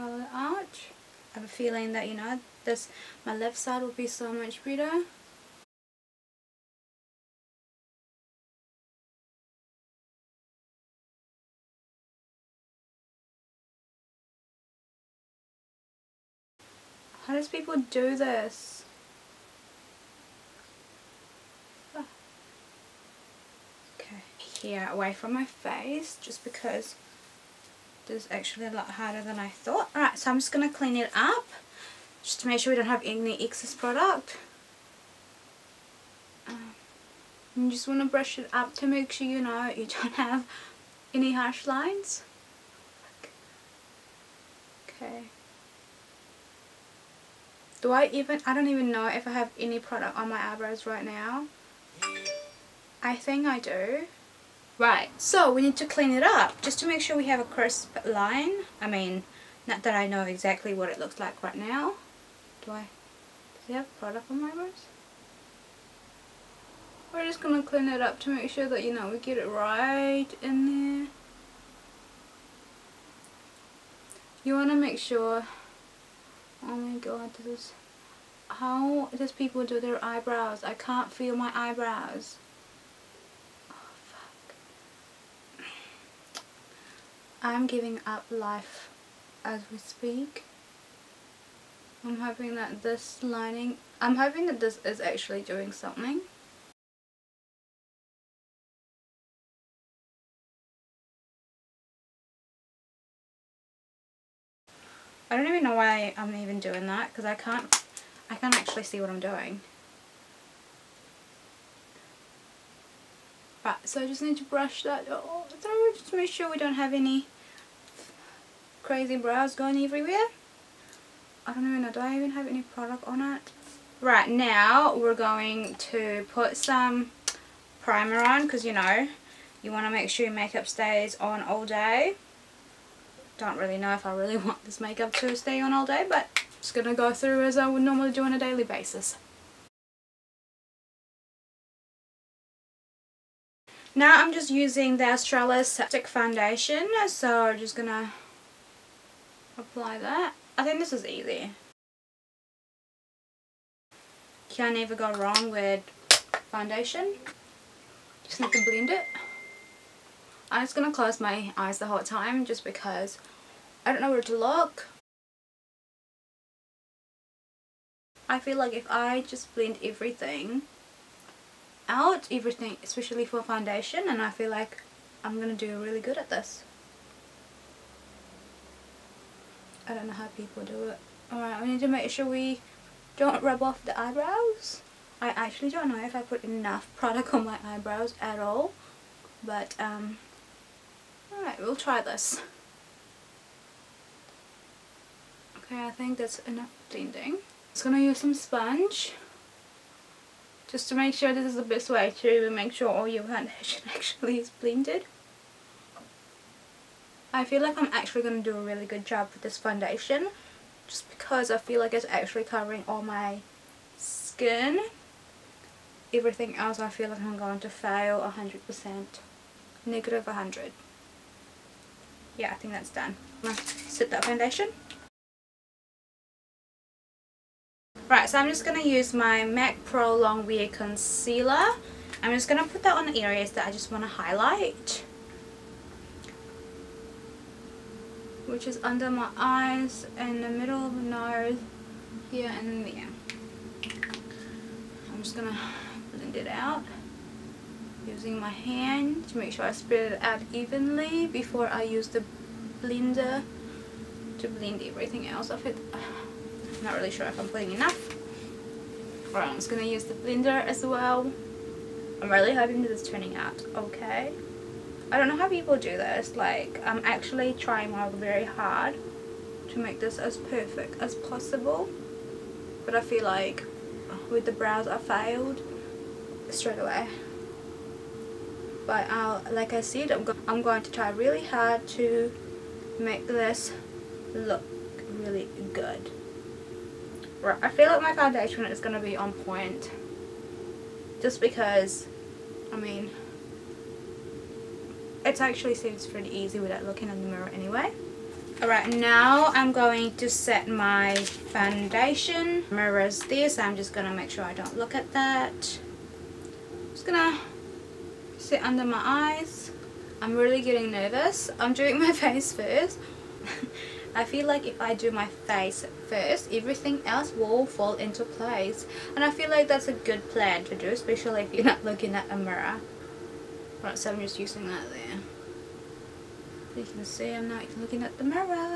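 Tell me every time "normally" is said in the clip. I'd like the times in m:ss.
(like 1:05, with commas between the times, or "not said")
2:17.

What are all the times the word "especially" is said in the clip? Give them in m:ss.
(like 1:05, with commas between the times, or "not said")
2:52, 5:20.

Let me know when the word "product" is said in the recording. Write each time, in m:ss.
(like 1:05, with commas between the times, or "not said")
0:33, 0:49, 1:03, 2:02, 3:06.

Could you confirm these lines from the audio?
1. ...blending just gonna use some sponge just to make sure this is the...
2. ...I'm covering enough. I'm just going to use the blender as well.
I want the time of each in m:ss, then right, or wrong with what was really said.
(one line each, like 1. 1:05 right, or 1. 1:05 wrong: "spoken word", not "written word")
1. 3:16 right
2. 4:17 wrong: "blending", not "covering".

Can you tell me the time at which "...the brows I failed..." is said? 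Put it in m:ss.
4:34.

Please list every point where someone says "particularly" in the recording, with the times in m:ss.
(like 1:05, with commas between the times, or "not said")
not said.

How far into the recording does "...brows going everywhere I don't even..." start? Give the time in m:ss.
1:59.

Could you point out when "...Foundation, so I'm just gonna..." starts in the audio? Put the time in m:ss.
2:26.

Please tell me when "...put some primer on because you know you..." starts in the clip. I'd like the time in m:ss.
2:06.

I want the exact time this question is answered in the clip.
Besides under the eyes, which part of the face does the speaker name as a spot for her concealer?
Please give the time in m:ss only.
4:00.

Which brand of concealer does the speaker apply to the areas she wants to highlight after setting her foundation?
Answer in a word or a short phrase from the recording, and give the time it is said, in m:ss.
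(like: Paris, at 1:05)
MAC Pro Wear, at 3:49.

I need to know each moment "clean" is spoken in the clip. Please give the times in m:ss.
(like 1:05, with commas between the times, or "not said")
0:30, 0:55, 1:07.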